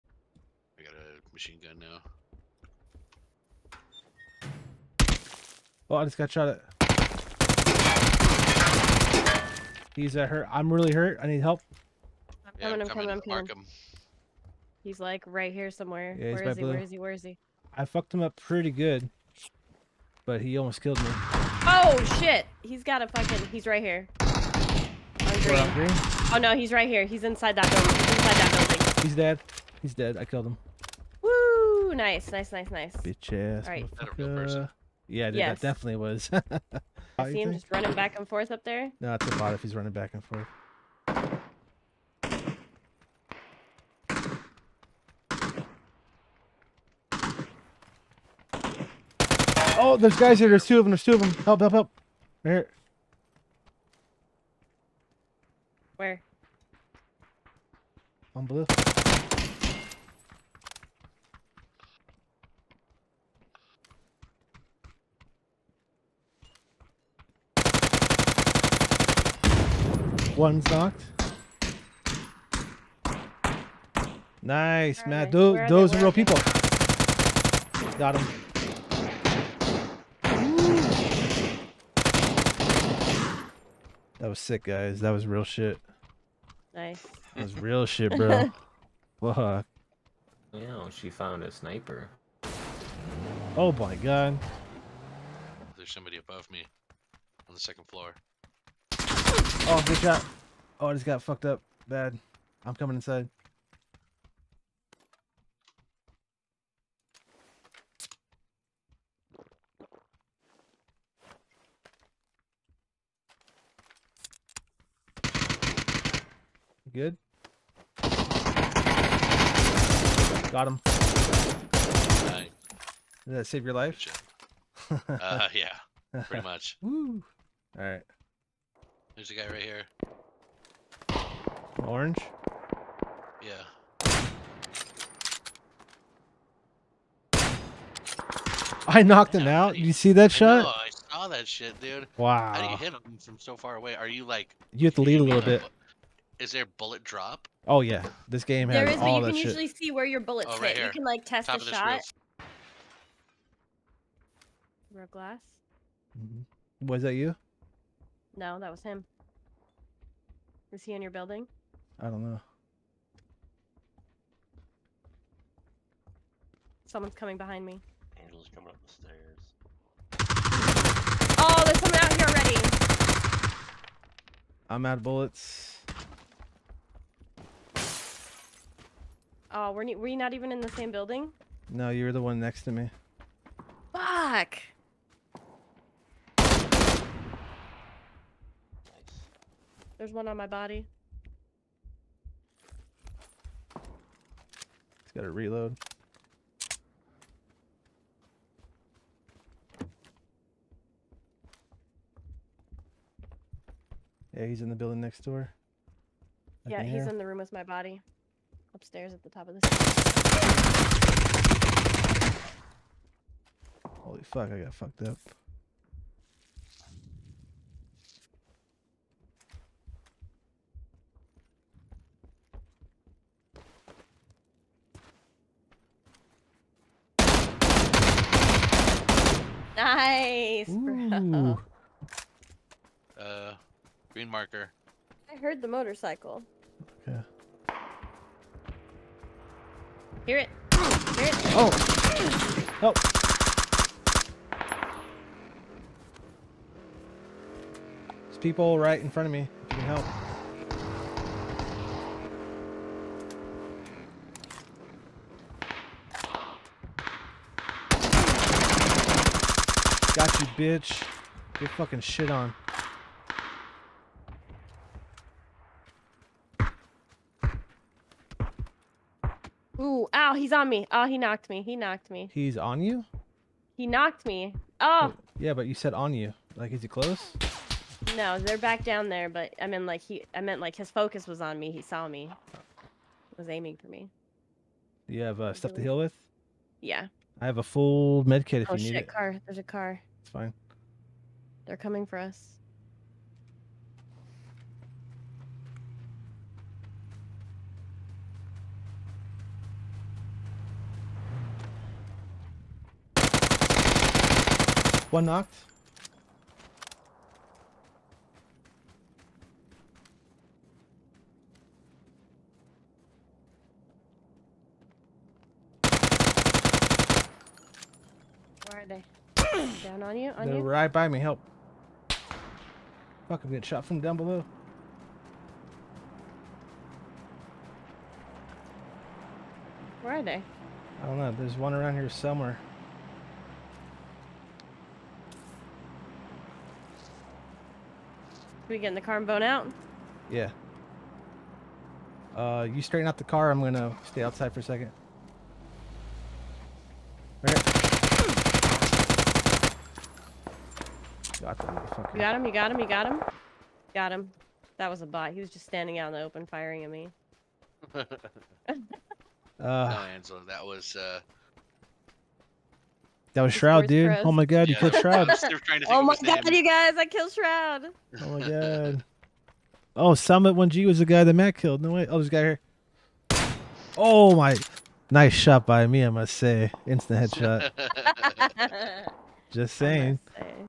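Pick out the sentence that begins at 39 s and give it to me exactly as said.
No, it's a bot if he's running back and forth.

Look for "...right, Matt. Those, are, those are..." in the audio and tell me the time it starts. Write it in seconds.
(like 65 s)
75 s.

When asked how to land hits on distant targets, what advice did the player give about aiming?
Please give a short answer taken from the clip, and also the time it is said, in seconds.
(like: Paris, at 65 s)
Lead a little bit, at 145 s.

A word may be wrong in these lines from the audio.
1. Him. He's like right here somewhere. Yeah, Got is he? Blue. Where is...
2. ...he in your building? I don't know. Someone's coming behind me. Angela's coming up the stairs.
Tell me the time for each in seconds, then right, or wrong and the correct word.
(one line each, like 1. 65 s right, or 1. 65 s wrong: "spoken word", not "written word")
1. 13 s wrong: "Where", not "Got"
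2. 160 s right.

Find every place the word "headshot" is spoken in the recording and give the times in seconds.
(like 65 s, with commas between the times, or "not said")
377 s.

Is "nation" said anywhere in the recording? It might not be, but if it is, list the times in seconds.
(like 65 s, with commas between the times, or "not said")
not said.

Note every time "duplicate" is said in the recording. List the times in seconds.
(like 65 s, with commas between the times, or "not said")
not said.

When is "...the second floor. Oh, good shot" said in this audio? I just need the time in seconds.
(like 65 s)
97 s.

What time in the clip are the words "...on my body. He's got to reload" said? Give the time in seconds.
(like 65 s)
190 s.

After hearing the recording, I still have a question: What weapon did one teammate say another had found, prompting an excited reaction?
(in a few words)
Sniper.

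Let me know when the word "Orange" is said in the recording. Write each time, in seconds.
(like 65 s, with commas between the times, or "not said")
131 s.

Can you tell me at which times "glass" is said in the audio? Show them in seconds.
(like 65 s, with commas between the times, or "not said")
155 s.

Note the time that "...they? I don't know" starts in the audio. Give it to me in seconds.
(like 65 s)
330 s.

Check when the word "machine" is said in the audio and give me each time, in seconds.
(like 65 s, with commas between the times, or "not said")
1 s.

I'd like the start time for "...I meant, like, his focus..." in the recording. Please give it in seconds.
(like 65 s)
280 s.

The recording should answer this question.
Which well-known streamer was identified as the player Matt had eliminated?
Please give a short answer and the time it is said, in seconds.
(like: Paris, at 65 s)
Summit 1G, at 370 s.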